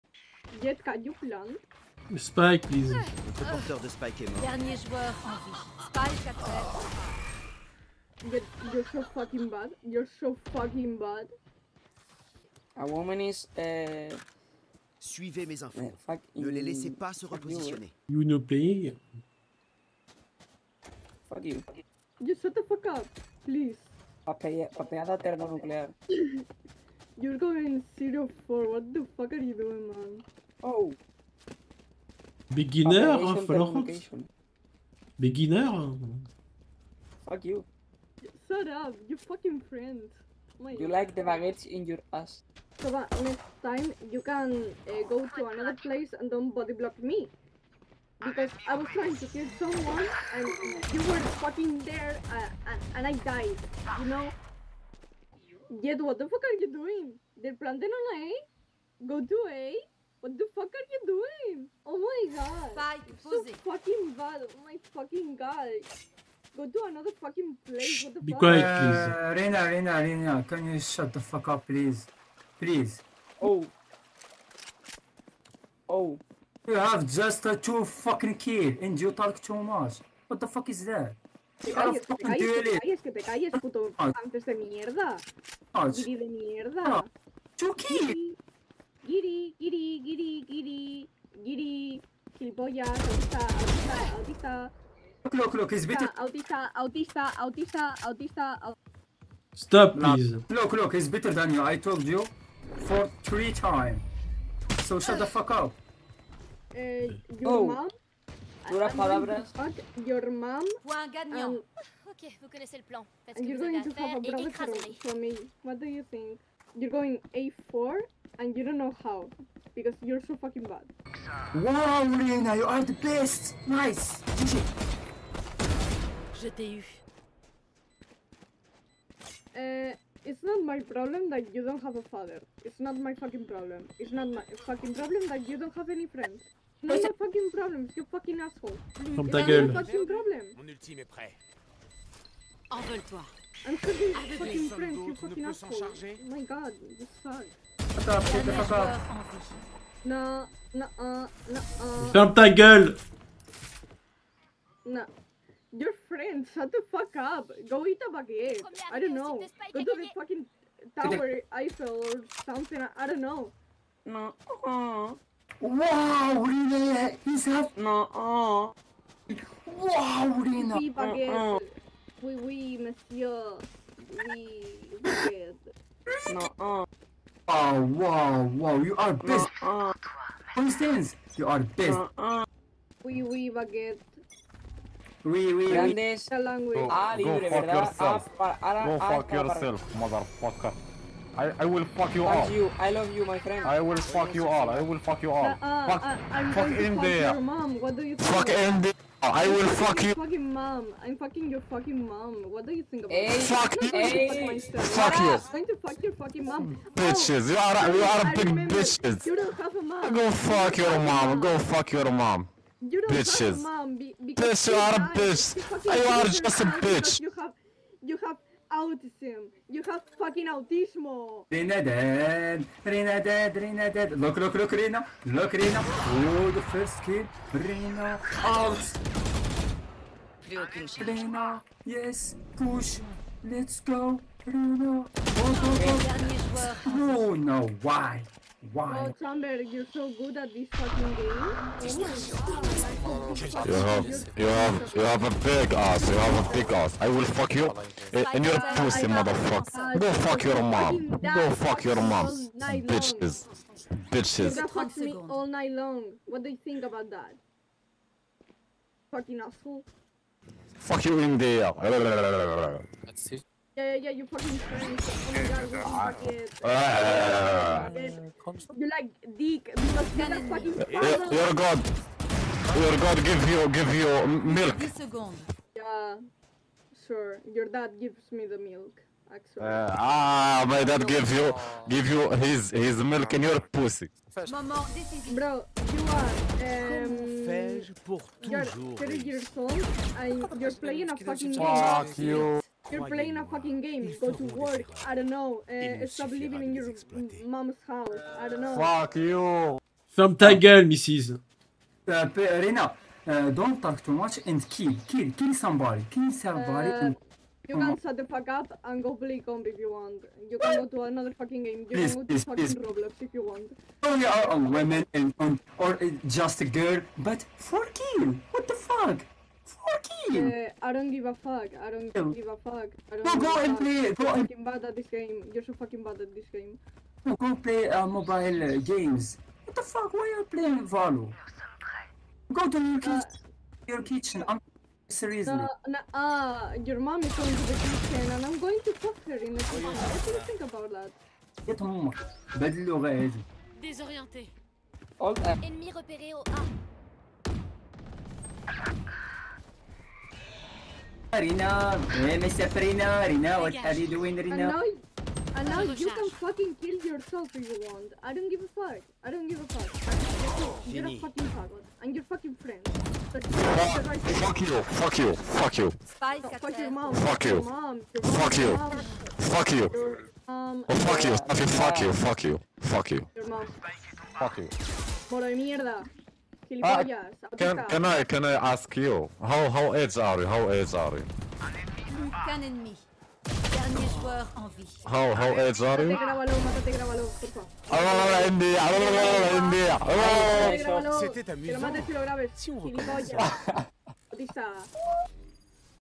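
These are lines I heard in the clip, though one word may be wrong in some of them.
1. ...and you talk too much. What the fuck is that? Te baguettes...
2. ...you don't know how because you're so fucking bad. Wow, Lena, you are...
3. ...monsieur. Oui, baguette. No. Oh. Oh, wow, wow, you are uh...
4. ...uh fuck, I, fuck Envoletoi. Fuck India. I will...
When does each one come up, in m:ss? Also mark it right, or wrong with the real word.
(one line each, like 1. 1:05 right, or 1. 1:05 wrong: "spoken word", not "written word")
1. 1:18 wrong: "calles", not "baguettes"
2. 1:58 right
3. 2:52 right
4. 3:15 wrong: "India", not "Envoletoi".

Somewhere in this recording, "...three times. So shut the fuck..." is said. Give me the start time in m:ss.
1:43.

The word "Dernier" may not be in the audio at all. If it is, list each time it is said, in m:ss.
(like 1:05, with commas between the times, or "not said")
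0:04.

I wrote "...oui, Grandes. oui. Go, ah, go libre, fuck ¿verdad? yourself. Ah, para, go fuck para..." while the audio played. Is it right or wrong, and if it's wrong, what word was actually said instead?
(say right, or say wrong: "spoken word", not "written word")
right.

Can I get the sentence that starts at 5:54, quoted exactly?
And now, and now you can fucking kill yourself if you want.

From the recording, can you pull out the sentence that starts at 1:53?
you're going to have à brother for me.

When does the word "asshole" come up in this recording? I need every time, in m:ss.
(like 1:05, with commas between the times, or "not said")
2:18, 2:25, 4:19.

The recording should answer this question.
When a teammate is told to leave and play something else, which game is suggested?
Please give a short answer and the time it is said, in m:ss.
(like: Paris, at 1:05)
Roblox, at 5:12.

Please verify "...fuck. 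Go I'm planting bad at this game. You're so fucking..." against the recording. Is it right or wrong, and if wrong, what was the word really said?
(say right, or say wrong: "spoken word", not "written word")
wrong: "fucking", not "planting".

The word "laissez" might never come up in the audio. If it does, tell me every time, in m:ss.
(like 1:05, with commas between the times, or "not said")
0:16.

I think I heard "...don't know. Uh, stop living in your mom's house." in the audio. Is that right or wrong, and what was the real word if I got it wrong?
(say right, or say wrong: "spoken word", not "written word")
right.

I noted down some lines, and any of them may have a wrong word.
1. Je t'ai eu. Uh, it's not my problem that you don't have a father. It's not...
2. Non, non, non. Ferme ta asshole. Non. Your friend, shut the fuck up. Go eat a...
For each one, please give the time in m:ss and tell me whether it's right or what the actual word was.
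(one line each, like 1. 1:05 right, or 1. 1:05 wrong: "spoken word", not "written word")
1. 2:06 right
2. 2:30 wrong: "gueule", not "asshole".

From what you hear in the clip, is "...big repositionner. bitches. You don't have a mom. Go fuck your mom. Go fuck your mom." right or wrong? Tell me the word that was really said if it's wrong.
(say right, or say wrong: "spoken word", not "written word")
wrong: "remember", not "repositionner".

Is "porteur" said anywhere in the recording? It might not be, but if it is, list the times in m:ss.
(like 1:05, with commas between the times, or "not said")
0:03.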